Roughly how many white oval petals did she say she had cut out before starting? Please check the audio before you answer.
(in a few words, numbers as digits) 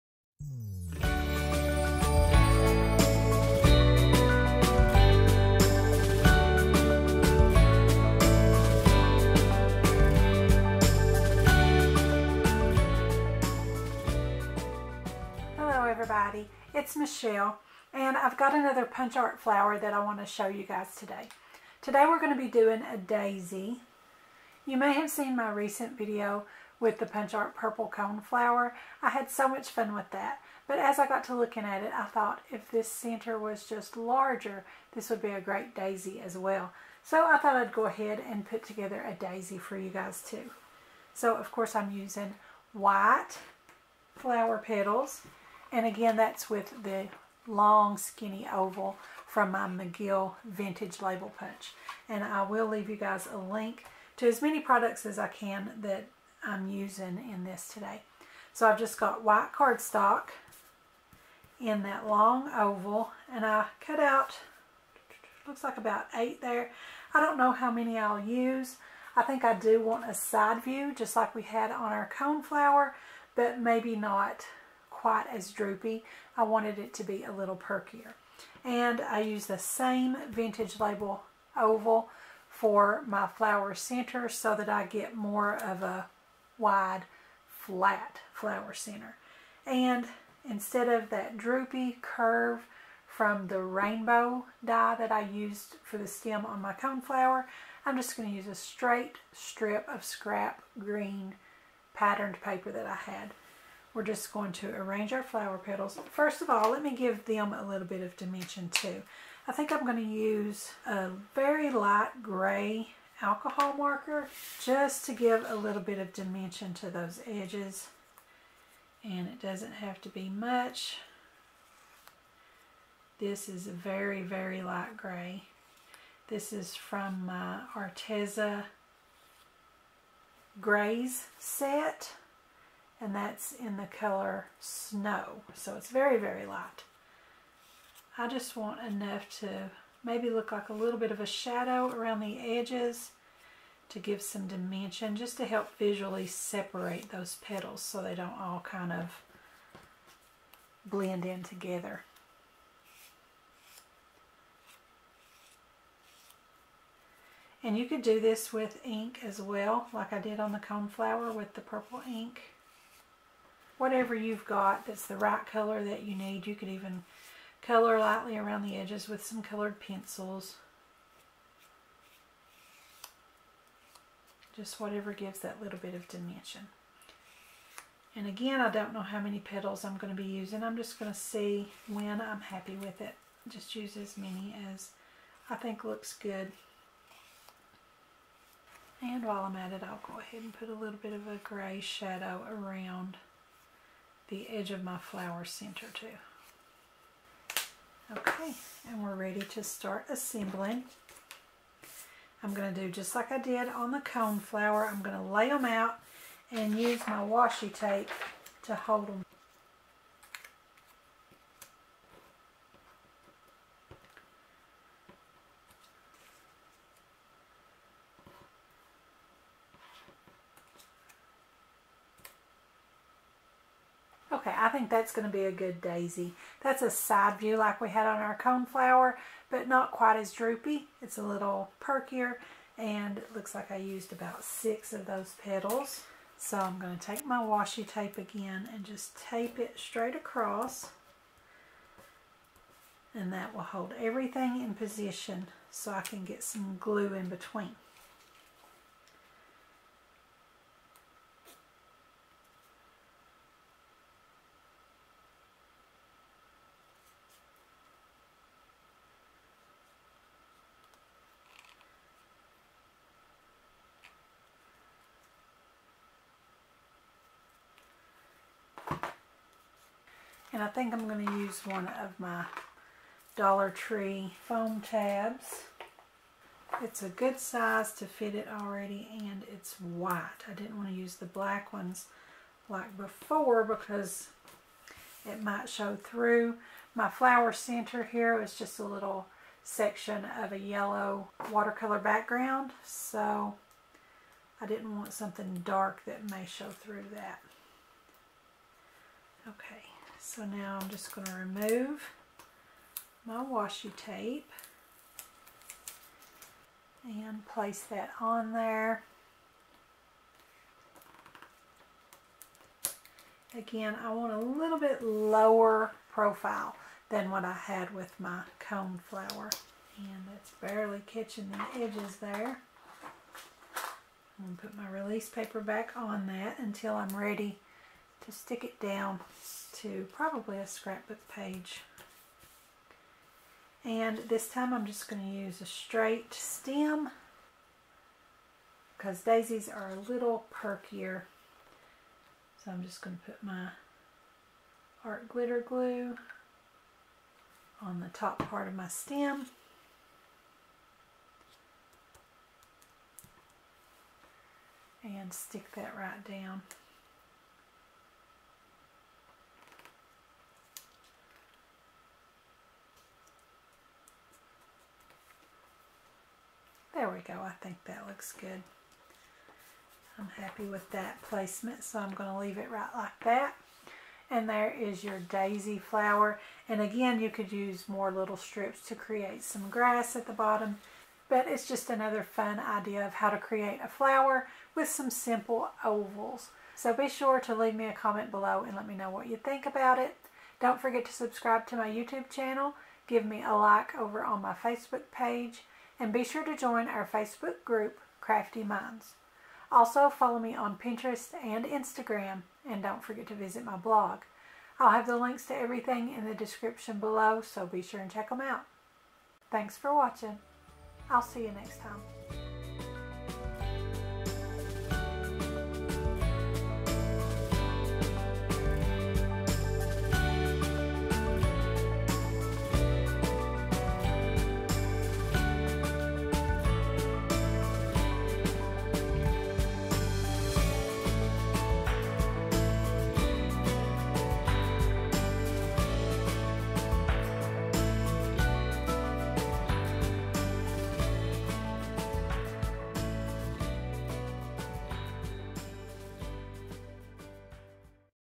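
8.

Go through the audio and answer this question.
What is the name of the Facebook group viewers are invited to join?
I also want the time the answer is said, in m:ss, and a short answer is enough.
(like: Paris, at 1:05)
Craftie Minds, at 6:38.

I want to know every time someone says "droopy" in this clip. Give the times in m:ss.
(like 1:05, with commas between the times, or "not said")
1:15, 1:31, 3:50.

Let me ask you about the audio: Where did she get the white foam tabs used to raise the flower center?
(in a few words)
Dollar Tree.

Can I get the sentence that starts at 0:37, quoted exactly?
So I thought I'd go ahead and put together a daisy for you guys too.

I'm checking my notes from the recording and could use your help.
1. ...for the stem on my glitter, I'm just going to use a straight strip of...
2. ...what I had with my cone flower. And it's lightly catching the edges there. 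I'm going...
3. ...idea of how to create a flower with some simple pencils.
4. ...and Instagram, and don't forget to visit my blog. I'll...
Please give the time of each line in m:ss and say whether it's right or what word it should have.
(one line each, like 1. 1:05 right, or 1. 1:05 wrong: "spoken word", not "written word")
1. 1:35 wrong: "coneflower", not "glitter"
2. 5:17 wrong: "barely", not "lightly"
3. 6:22 wrong: "ovals", not "pencils"
4. 6:41 right.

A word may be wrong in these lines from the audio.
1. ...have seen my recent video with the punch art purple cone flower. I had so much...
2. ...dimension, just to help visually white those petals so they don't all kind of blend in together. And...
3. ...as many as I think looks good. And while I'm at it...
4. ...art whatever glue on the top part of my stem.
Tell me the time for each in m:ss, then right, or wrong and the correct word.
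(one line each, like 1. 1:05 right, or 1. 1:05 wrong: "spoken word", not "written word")
1. 0:24 right
2. 2:24 wrong: "separate", not "white"
3. 3:03 right
4. 5:45 wrong: "glitter", not "whatever".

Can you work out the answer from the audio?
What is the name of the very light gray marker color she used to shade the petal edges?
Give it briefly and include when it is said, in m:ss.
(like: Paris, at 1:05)
Snow, at 2:14.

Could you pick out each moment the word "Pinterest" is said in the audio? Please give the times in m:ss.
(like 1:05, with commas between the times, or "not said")
6:40.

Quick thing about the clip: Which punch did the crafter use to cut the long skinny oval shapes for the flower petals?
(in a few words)
McGill Vintage Label Punch.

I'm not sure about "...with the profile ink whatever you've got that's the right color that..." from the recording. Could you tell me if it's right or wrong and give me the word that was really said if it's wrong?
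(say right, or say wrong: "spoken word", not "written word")
wrong: "purple", not "profile".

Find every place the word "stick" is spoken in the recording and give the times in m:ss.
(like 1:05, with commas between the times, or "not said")
5:28, 5:55.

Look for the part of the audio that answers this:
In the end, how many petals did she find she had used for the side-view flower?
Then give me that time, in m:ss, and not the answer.
3:54.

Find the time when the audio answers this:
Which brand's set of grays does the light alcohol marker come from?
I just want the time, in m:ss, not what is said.
2:07.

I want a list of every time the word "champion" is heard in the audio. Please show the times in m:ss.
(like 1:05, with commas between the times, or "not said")
not said.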